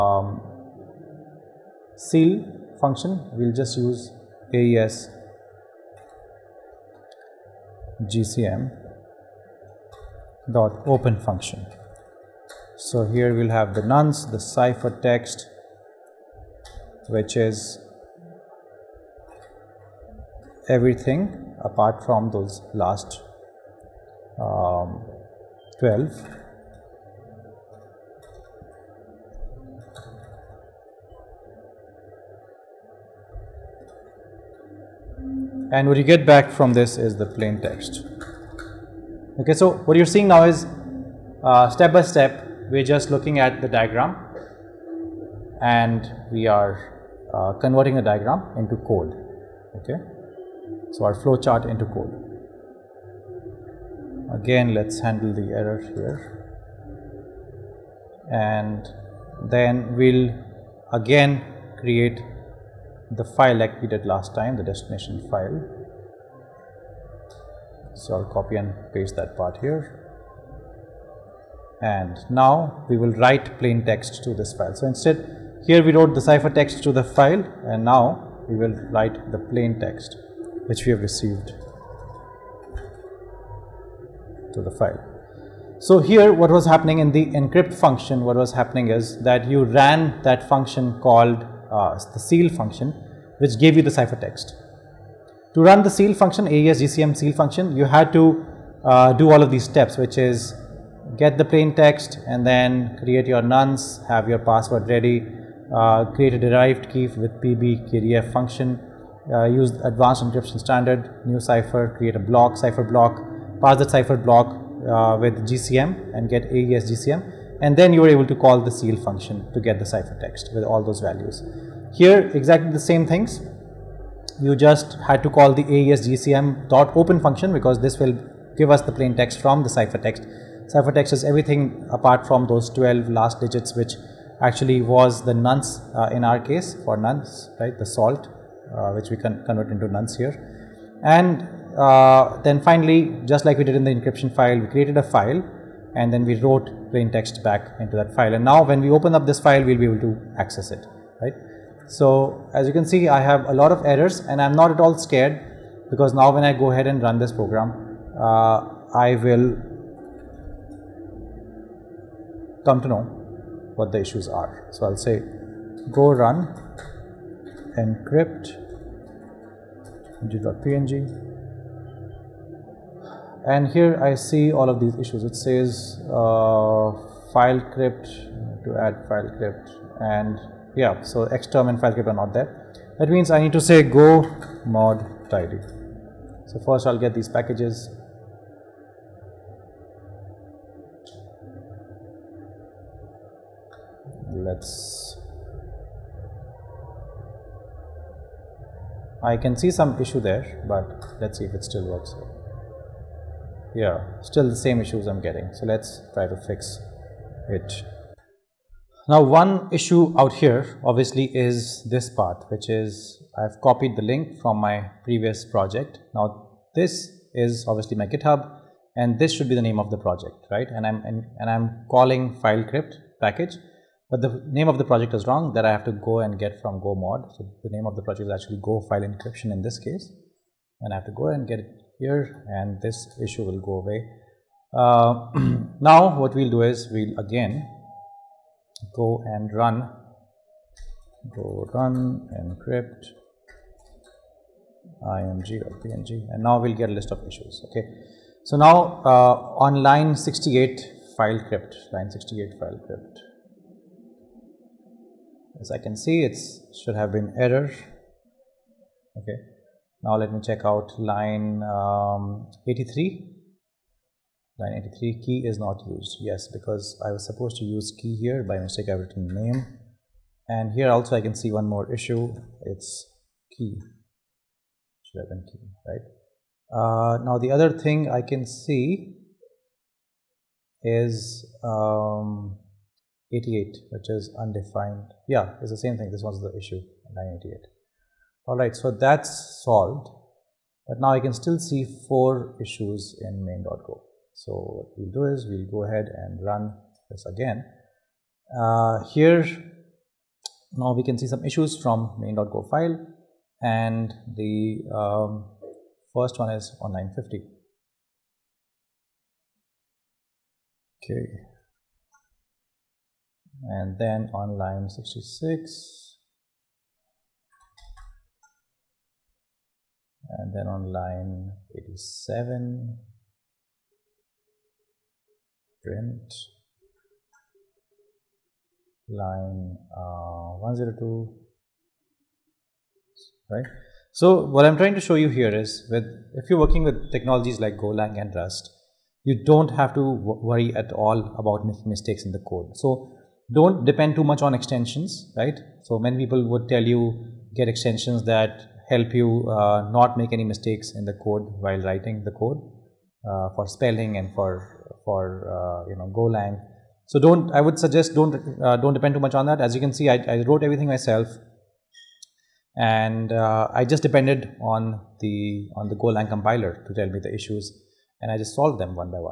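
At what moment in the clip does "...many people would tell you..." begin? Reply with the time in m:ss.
5:45.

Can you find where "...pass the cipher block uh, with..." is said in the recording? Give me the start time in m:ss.
1:53.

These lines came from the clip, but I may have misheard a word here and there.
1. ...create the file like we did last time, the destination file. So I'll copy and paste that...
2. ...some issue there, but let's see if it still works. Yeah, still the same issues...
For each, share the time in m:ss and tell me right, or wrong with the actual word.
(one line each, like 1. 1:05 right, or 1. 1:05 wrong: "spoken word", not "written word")
1. 1:01 right
2. 3:19 right.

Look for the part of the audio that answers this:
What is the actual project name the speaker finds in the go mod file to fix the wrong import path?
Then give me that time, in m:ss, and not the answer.
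3:48.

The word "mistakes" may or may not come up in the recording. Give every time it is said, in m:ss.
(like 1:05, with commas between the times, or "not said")
4:28, 5:41, 5:50.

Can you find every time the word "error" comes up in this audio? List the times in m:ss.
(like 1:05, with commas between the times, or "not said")
0:55, 2:33, 4:17.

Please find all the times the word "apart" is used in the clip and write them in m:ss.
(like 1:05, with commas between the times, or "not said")
0:21, 2:11.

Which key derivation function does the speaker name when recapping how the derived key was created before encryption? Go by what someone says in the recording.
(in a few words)
pbkdf.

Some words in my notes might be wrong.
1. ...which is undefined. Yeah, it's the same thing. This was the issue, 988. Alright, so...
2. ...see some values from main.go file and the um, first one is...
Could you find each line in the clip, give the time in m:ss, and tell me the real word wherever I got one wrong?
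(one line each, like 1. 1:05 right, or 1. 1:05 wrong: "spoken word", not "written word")
1. 4:43 right
2. 5:01 wrong: "issues", not "values".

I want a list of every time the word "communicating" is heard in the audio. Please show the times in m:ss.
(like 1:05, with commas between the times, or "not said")
not said.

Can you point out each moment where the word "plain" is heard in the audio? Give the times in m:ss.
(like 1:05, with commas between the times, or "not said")
0:37, 1:13, 1:19, 1:41, 2:08, 2:26.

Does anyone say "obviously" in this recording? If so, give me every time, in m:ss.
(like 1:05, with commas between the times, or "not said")
3:30, 3:37.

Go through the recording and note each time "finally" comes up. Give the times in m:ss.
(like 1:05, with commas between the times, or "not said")
2:22.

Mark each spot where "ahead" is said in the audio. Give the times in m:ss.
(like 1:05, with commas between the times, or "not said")
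2:36, 4:55.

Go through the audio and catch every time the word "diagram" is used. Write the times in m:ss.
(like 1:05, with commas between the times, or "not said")
0:43, 0:48.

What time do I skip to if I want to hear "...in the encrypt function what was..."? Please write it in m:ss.
1:26.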